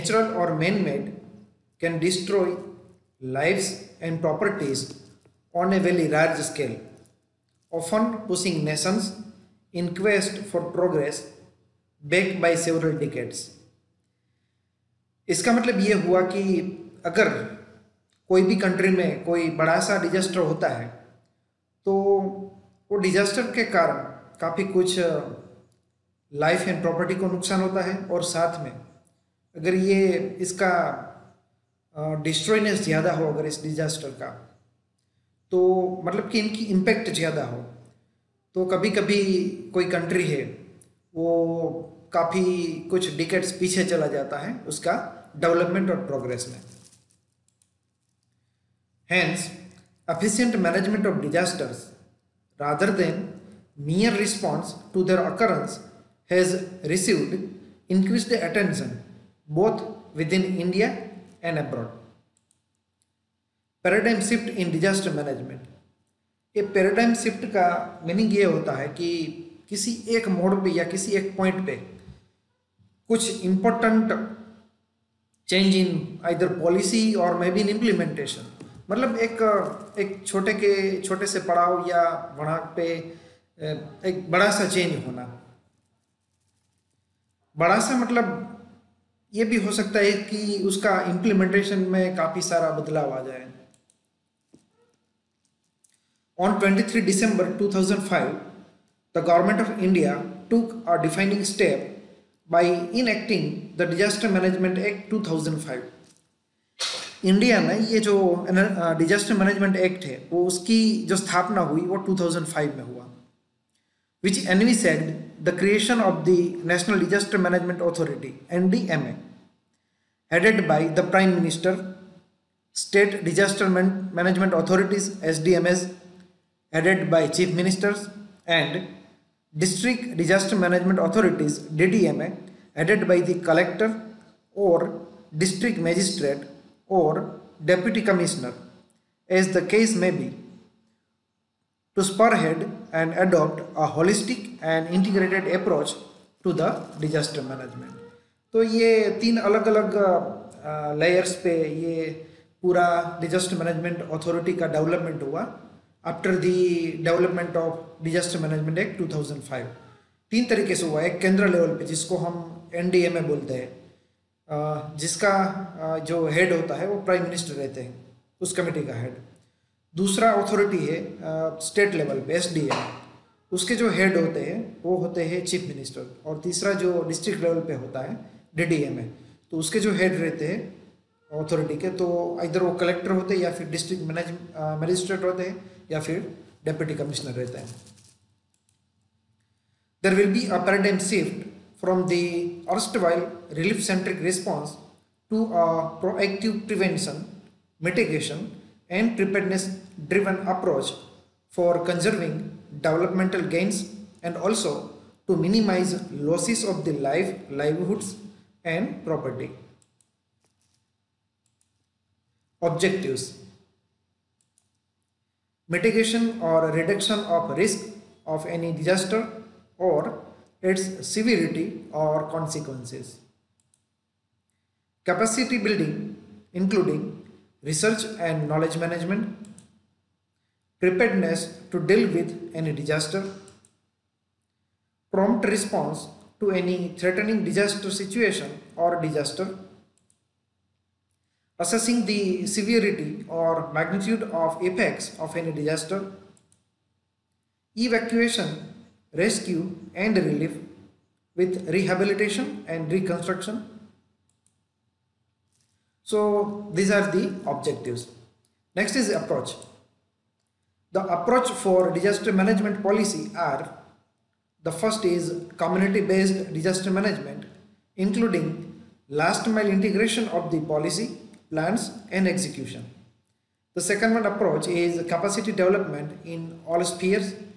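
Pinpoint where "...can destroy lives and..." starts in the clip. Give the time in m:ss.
0:01.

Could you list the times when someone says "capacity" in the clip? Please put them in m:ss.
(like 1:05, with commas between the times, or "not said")
3:45, 4:35.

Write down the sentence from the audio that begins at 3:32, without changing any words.
Objectives mitigation or reduction of risk of any disaster or its severity or consequences.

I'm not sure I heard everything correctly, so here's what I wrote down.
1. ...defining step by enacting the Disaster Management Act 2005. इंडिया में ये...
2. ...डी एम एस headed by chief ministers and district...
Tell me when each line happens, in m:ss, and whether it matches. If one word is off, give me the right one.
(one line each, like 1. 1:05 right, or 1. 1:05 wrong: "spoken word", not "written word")
1. 1:41 right
2. 2:05 right.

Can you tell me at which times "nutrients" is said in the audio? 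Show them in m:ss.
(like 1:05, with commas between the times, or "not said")
not said.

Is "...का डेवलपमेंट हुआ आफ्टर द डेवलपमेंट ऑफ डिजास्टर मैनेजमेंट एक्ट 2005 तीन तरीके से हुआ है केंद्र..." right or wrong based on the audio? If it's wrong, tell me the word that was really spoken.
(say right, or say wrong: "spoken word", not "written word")
right.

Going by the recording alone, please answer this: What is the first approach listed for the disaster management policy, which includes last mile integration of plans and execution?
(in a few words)
Community based disaster management.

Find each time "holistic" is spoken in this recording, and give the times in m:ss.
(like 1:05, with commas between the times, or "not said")
2:23.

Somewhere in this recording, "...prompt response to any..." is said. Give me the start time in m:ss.
3:55.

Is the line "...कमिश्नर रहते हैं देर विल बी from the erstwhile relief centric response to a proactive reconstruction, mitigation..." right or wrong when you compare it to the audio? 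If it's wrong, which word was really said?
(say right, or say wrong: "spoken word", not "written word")
wrong: "prevention", not "reconstruction".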